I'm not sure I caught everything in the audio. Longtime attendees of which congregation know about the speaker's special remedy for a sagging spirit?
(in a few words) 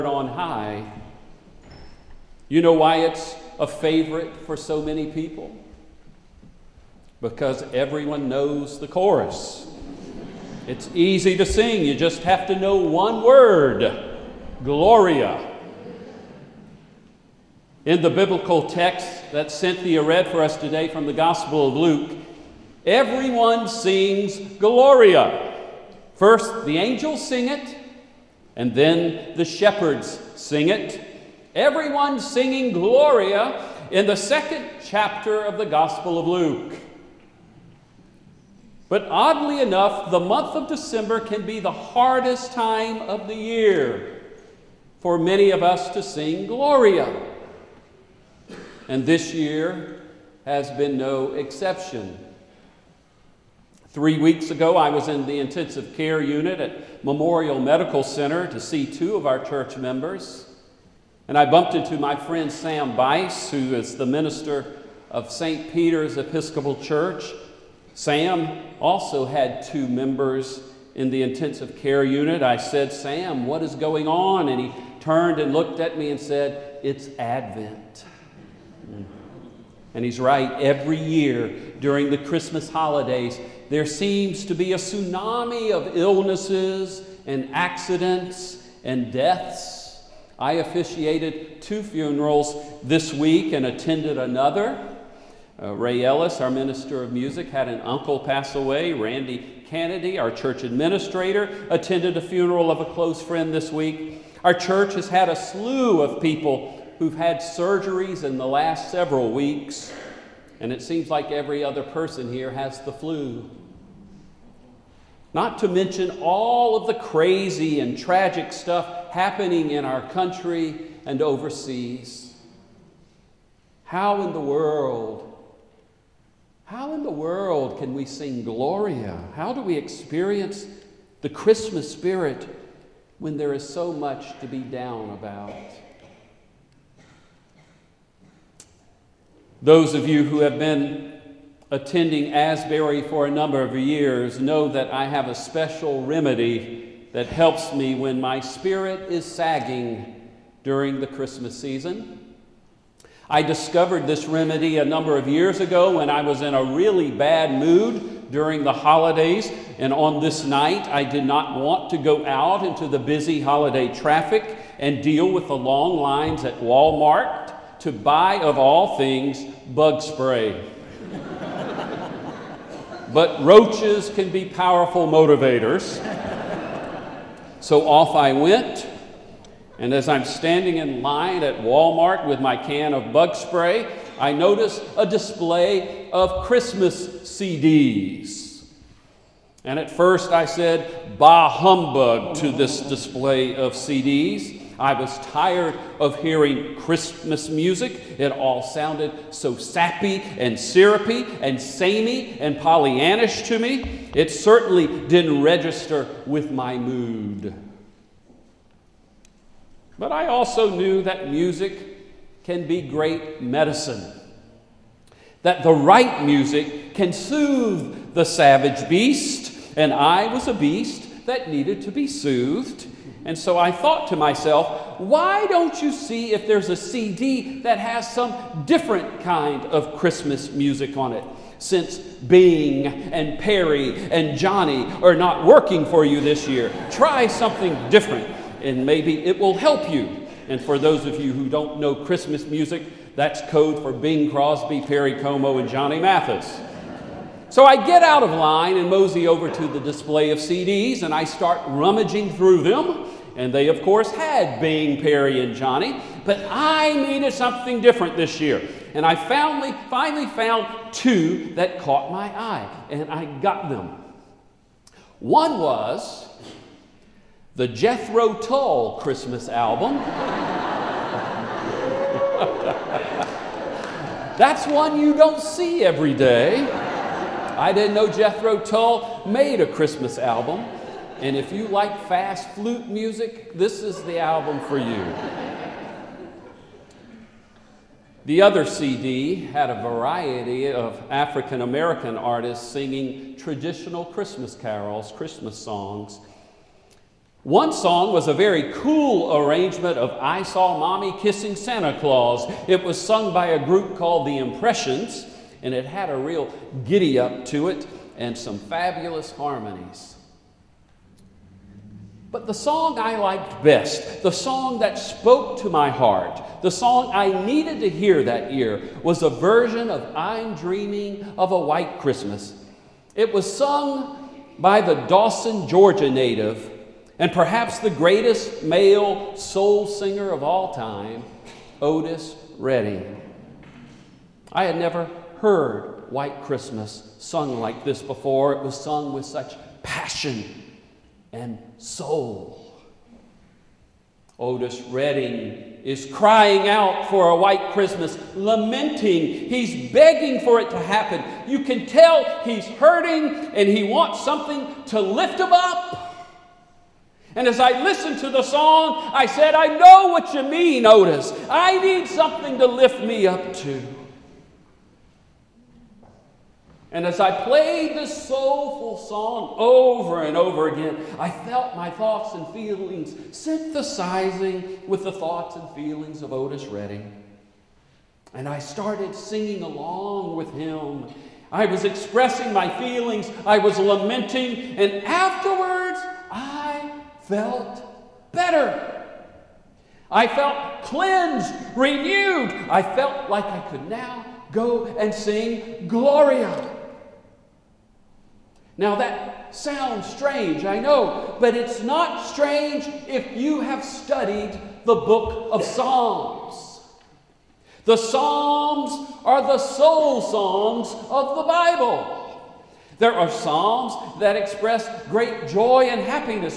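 Asbury.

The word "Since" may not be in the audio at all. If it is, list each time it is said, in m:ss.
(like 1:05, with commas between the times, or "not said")
3:51.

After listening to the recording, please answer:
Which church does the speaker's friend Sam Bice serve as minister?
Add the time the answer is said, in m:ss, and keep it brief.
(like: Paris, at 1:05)
St. Peter's Episcopal Church, at 1:05.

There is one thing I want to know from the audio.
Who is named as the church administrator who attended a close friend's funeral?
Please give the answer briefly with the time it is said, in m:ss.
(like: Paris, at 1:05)
Randy Kennedy, at 1:38.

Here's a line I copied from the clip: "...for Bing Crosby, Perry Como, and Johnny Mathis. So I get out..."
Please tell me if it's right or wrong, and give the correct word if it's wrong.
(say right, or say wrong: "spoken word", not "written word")
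right.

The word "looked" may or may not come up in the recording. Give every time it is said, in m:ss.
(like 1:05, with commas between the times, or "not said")
1:15.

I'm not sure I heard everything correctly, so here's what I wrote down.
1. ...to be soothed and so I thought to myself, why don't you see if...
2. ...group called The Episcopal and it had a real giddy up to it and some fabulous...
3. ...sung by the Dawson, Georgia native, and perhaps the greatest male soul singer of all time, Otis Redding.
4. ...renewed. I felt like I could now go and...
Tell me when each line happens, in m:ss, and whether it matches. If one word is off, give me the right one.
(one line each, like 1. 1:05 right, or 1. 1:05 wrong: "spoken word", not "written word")
1. 3:41 right
2. 5:03 wrong: "Impressions", not "Episcopal"
3. 5:23 right
4. 6:31 right.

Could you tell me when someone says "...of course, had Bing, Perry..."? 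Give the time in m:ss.
4:13.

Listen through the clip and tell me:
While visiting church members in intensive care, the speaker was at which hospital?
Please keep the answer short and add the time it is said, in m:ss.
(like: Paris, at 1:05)
Memorial Medical Center, at 0:57.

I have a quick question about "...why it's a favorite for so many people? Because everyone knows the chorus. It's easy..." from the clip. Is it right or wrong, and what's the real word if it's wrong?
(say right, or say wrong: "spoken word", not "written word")
right.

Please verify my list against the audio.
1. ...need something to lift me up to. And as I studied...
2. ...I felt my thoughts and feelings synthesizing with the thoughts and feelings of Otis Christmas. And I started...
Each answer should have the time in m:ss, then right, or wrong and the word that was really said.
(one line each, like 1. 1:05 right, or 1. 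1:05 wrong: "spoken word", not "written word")
1. 6:01 wrong: "played", not "studied"
2. 6:11 wrong: "Redding", not "Christmas".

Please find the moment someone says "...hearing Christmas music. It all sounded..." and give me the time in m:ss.
3:16.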